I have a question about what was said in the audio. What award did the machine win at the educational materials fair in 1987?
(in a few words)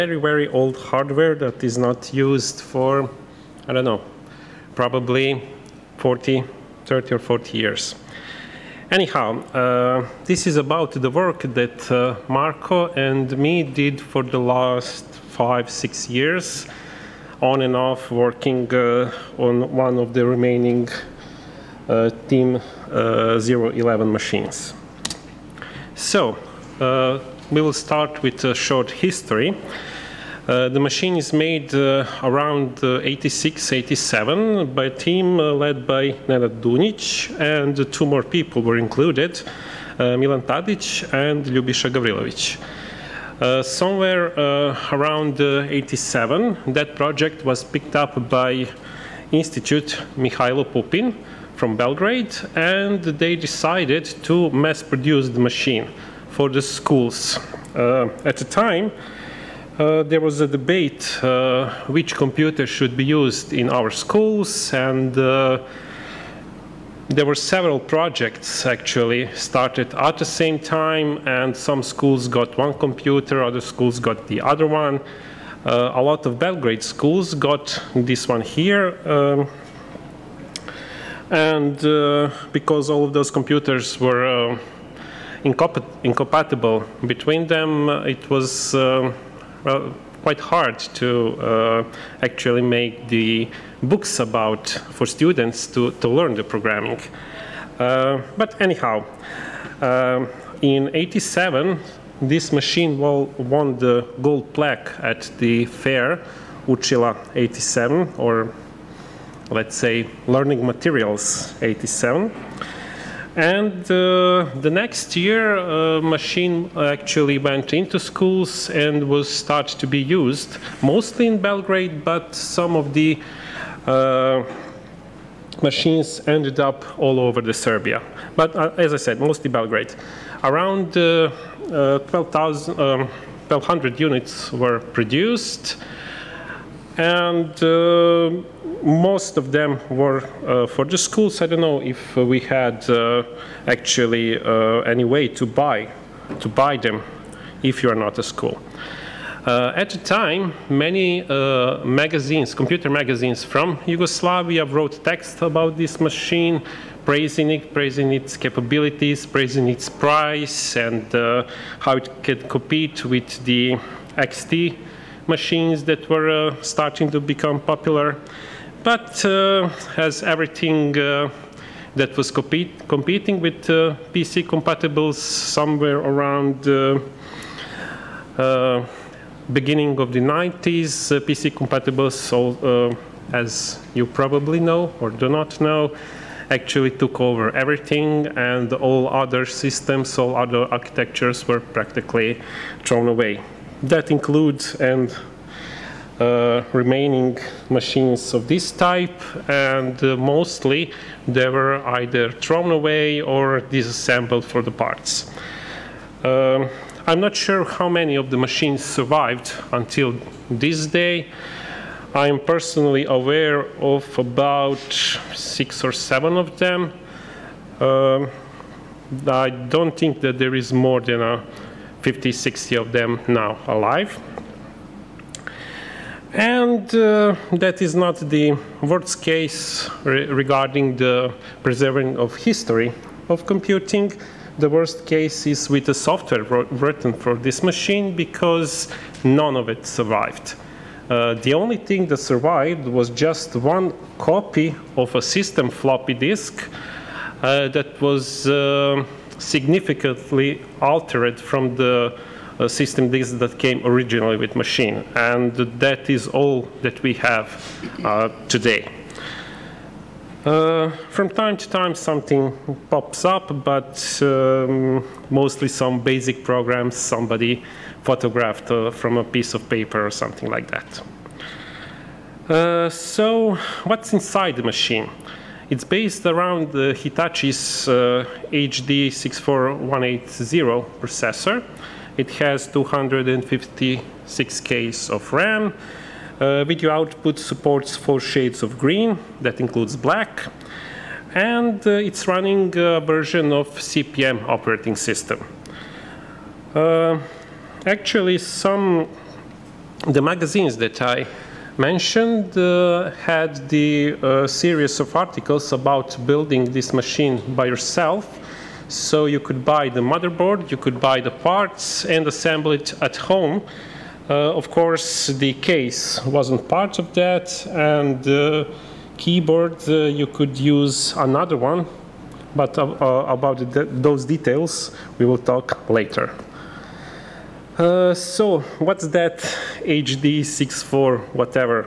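gold plaque.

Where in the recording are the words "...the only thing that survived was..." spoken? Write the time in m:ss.
4:01.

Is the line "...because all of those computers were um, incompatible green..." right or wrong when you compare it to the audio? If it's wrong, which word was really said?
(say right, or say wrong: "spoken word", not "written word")
wrong: "between", not "green".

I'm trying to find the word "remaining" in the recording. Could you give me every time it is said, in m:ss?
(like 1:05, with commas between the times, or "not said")
0:20, 3:16.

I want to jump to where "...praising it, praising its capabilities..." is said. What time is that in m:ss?
2:37.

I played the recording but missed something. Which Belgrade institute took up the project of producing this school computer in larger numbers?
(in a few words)
Mihailo Pupin.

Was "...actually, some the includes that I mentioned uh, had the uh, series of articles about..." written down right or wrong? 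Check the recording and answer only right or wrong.
wrong.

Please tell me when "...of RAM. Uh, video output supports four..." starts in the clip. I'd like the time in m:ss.
4:45.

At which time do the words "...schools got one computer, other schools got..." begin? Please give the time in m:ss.
1:11.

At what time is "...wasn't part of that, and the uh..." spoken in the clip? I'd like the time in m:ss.
5:16.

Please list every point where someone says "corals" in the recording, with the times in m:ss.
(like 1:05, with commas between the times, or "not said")
not said.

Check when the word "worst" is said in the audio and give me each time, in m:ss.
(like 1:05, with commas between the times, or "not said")
3:48, 3:54.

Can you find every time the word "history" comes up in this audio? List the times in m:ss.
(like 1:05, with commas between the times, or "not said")
0:28, 3:52.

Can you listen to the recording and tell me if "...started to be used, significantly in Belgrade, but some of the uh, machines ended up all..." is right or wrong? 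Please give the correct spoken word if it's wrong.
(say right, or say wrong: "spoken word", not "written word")
wrong: "mostly", not "significantly".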